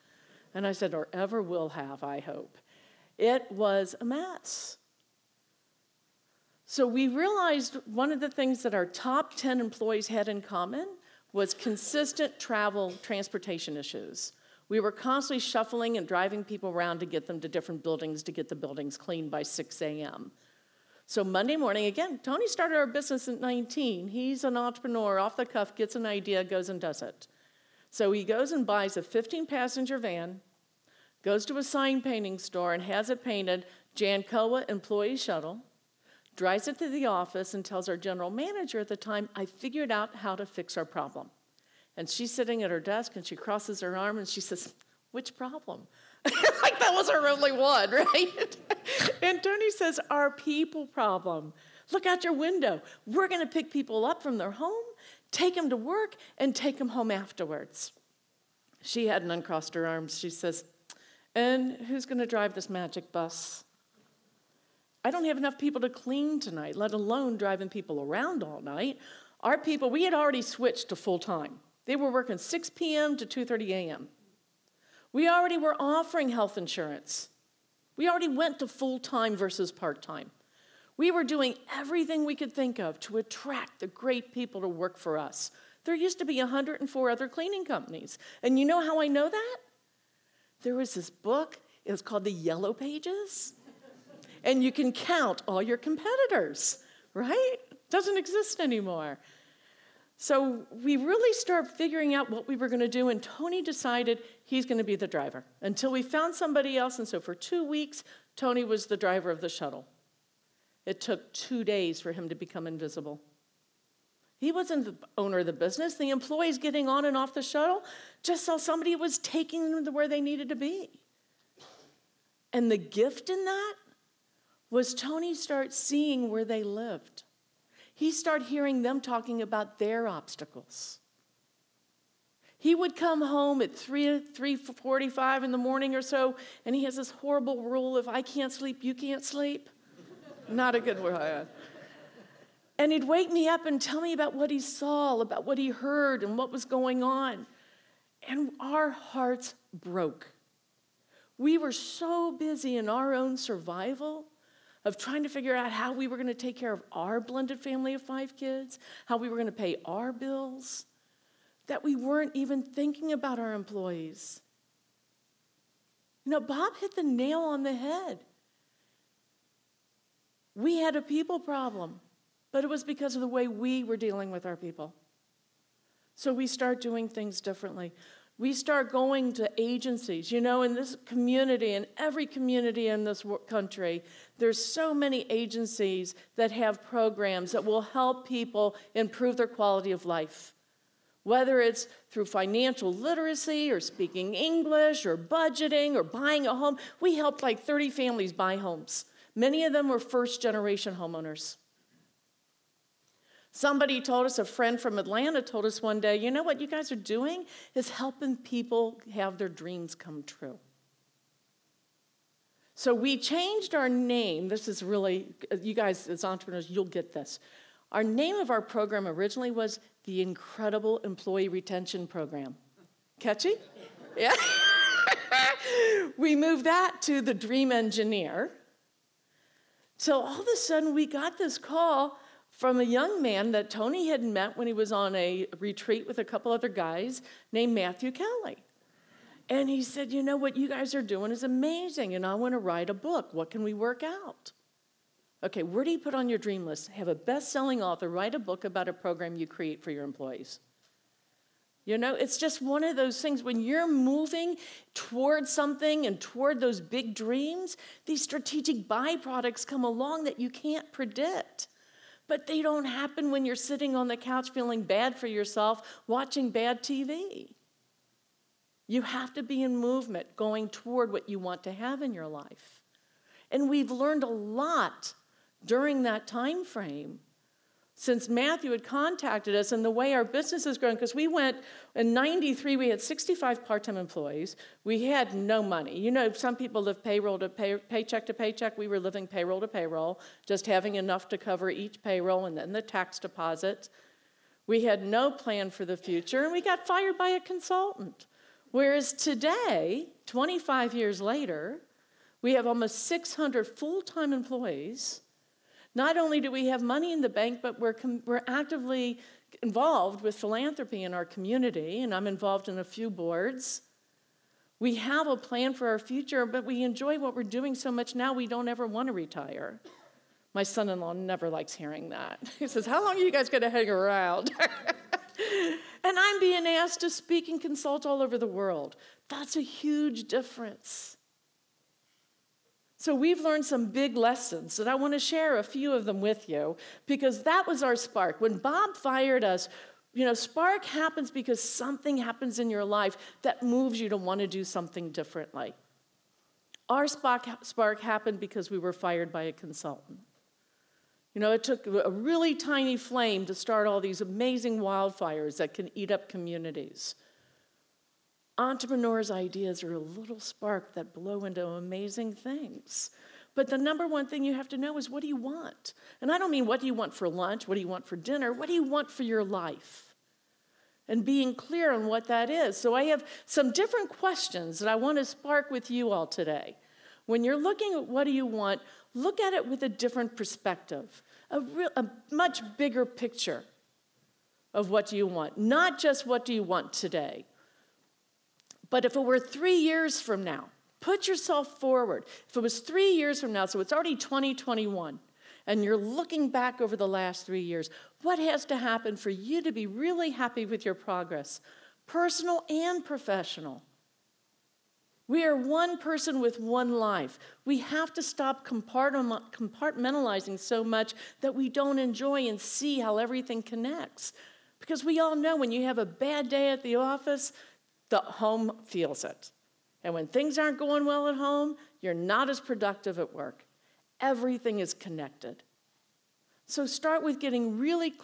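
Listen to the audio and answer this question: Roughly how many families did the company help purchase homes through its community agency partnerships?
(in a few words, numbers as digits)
30.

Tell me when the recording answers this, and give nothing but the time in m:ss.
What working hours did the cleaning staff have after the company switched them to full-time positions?
1:12.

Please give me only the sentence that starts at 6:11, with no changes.
And being clear on what that is.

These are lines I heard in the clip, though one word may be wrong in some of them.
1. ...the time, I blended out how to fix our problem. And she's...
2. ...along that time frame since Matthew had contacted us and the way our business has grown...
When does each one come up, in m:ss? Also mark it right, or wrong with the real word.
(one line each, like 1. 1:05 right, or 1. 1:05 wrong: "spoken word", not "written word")
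1. 0:38 wrong: "figured", not "blended"
2. 4:35 wrong: "during", not "along".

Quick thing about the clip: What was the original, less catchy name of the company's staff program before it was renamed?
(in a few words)
Incredible Employee Retention Program.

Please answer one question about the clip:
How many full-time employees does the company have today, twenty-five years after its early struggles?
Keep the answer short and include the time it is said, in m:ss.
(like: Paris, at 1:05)
almost 600, at 5:02.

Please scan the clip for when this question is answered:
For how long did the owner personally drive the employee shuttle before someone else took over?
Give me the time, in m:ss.
1:47.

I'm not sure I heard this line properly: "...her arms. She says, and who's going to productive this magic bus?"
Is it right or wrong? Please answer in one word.
wrong.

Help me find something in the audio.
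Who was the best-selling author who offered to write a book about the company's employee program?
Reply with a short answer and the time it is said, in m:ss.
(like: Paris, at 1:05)
Matthew Kelly, at 3:57.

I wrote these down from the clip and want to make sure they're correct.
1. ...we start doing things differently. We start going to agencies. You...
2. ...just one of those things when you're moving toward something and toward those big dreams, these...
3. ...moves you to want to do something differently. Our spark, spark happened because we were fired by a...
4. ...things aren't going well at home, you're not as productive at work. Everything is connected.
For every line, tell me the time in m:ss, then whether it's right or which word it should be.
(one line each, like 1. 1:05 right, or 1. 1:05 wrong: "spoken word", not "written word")
1. 2:56 right
2. 4:12 right
3. 5:43 right
4. 7:00 right.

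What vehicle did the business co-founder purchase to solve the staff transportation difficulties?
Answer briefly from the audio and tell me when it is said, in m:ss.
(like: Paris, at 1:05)
15 passenger van, at 0:29.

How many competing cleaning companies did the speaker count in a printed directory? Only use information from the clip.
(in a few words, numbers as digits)
104.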